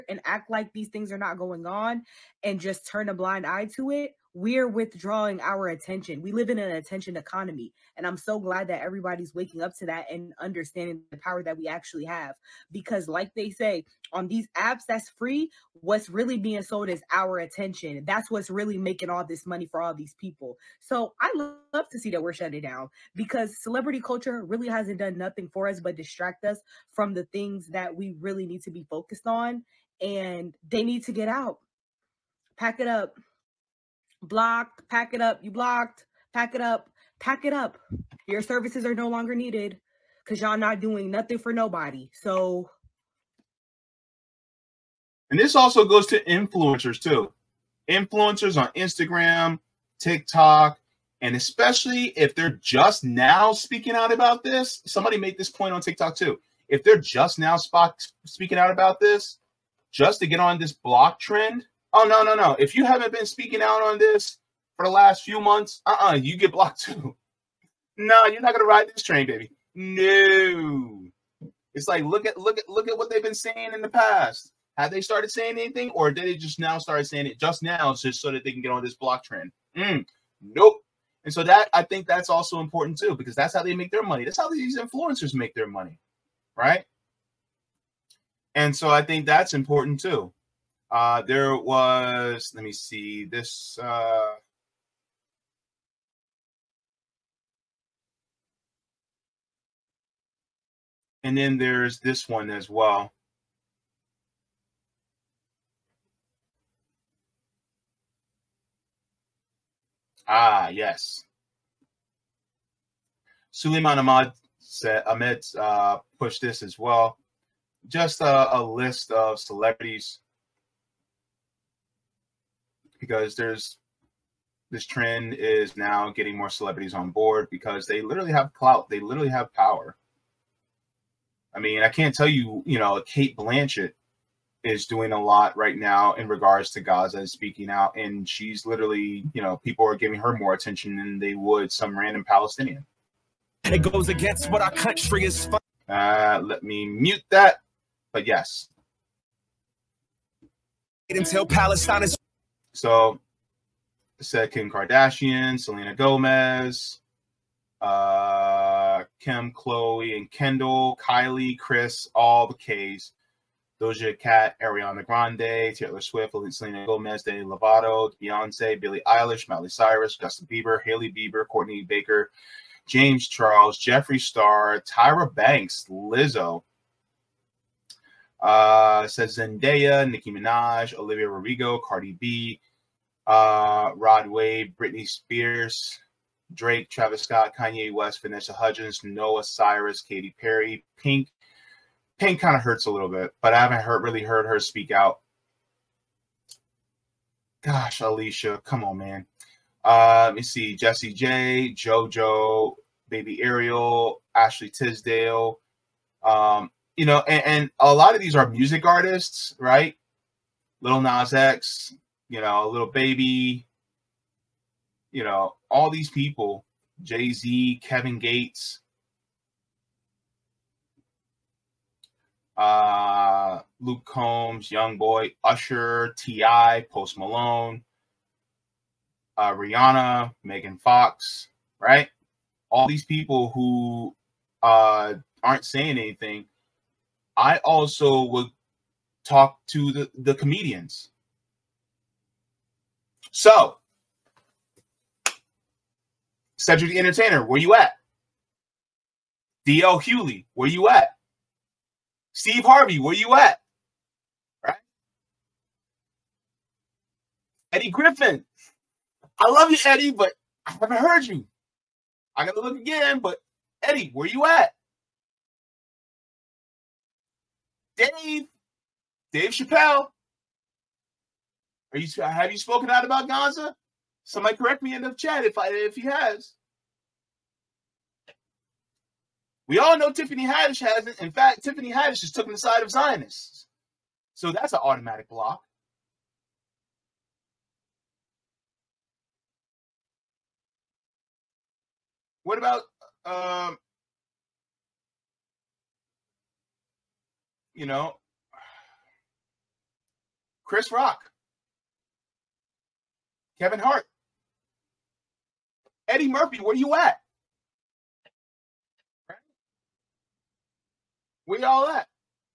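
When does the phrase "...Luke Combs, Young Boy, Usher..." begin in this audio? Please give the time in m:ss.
3:43.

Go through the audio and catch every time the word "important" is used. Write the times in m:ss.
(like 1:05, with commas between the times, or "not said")
1:22, 1:29.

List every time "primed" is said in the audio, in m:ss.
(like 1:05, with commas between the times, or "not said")
not said.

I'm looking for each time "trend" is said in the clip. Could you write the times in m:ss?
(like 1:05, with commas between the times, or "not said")
1:01, 1:19, 2:04.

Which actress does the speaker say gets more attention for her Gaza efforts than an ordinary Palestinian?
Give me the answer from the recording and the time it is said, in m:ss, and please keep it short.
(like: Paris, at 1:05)
Cate Blanchett, at 2:13.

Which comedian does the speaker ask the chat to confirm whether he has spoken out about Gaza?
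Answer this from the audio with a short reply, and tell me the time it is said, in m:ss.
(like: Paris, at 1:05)
Dave Chappelle, at 4:29.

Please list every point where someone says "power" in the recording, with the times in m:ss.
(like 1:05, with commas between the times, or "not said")
0:11, 2:09.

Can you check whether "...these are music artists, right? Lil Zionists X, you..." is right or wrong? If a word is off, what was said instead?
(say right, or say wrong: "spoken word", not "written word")
wrong: "Nas", not "Zionists".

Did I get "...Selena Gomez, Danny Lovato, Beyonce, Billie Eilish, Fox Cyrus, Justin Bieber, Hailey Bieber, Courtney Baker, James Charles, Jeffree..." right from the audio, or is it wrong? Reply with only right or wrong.
wrong.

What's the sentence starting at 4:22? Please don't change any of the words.
I gotta look again, but Eddie, where you at?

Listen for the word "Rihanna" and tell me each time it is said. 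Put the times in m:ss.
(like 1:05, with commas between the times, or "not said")
3:49.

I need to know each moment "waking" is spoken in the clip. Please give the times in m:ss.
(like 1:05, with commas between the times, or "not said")
0:09.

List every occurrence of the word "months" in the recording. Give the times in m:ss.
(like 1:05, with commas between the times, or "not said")
1:05.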